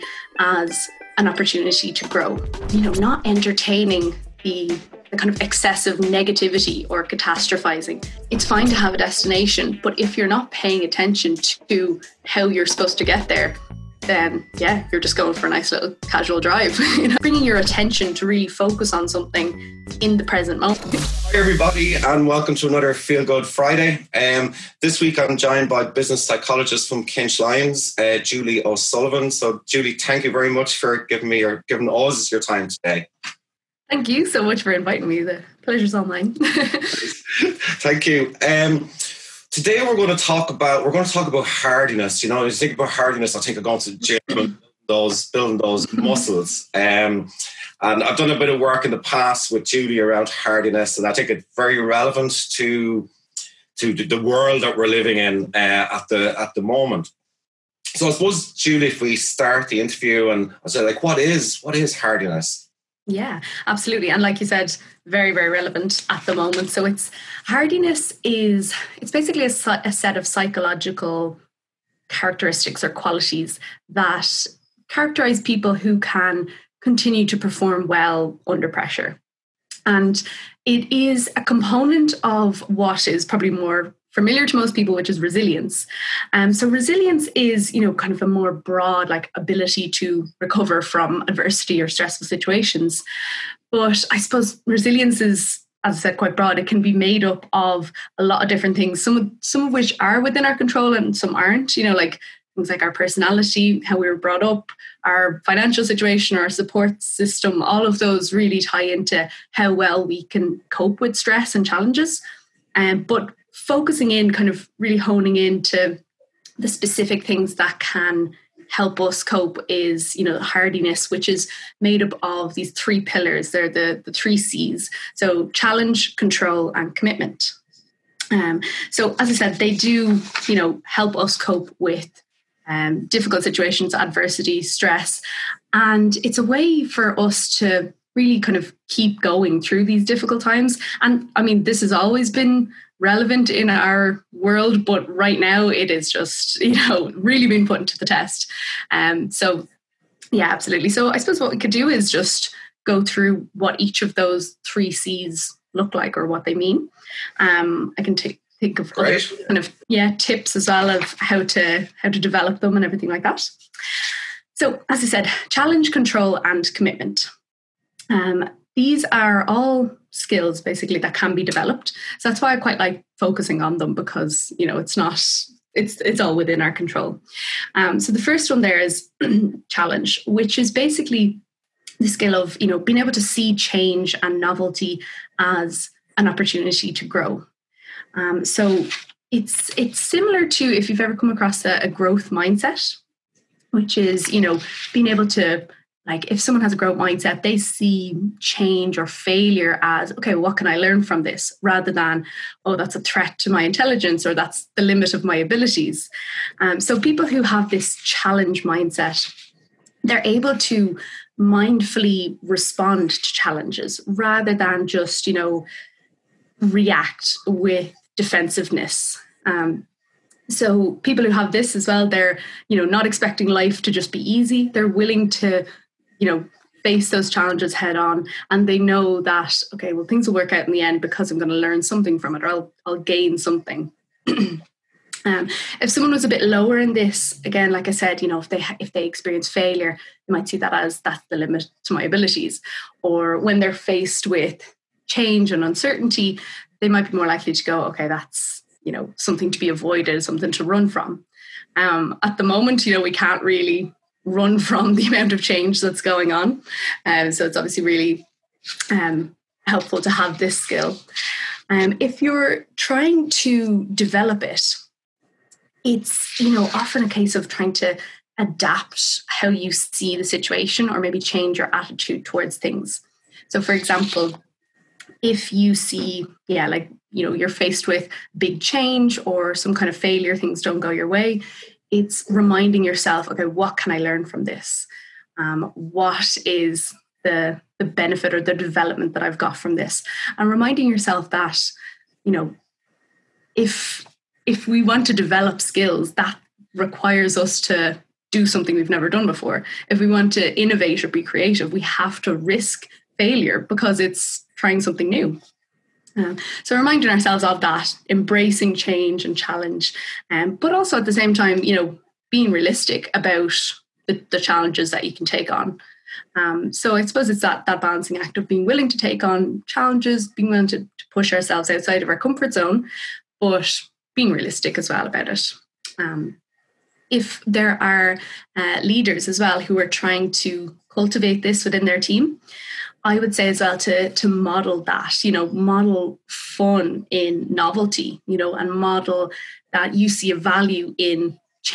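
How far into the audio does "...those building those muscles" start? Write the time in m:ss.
0:44.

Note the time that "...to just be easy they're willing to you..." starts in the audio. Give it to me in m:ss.
3:43.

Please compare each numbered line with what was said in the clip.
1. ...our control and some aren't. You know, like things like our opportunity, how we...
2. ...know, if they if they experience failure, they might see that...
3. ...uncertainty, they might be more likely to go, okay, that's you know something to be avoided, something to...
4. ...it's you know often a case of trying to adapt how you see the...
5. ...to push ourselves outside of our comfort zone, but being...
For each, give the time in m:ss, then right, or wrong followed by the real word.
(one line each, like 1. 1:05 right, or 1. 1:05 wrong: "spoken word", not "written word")
1. 1:40 wrong: "personality", not "opportunity"
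2. 3:58 right
3. 4:05 right
4. 4:25 right
5. 5:20 right.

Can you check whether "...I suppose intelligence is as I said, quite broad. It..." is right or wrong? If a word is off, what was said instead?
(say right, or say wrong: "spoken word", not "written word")
wrong: "resilience", not "intelligence".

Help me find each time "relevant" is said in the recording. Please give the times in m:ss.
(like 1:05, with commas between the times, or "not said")
0:51, 1:05, 2:22.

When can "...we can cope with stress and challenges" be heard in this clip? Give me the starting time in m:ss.
1:50.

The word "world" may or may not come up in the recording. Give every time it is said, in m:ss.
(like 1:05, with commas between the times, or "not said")
0:54, 2:24.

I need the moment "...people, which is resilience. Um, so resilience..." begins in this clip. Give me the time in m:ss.
1:24.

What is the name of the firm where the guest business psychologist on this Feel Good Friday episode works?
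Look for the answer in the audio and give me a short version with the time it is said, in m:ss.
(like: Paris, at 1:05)
KinchLyons, at 0:27.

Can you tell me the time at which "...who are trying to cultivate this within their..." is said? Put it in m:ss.
5:29.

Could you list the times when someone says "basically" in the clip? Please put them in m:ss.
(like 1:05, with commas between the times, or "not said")
1:09, 2:50, 3:00.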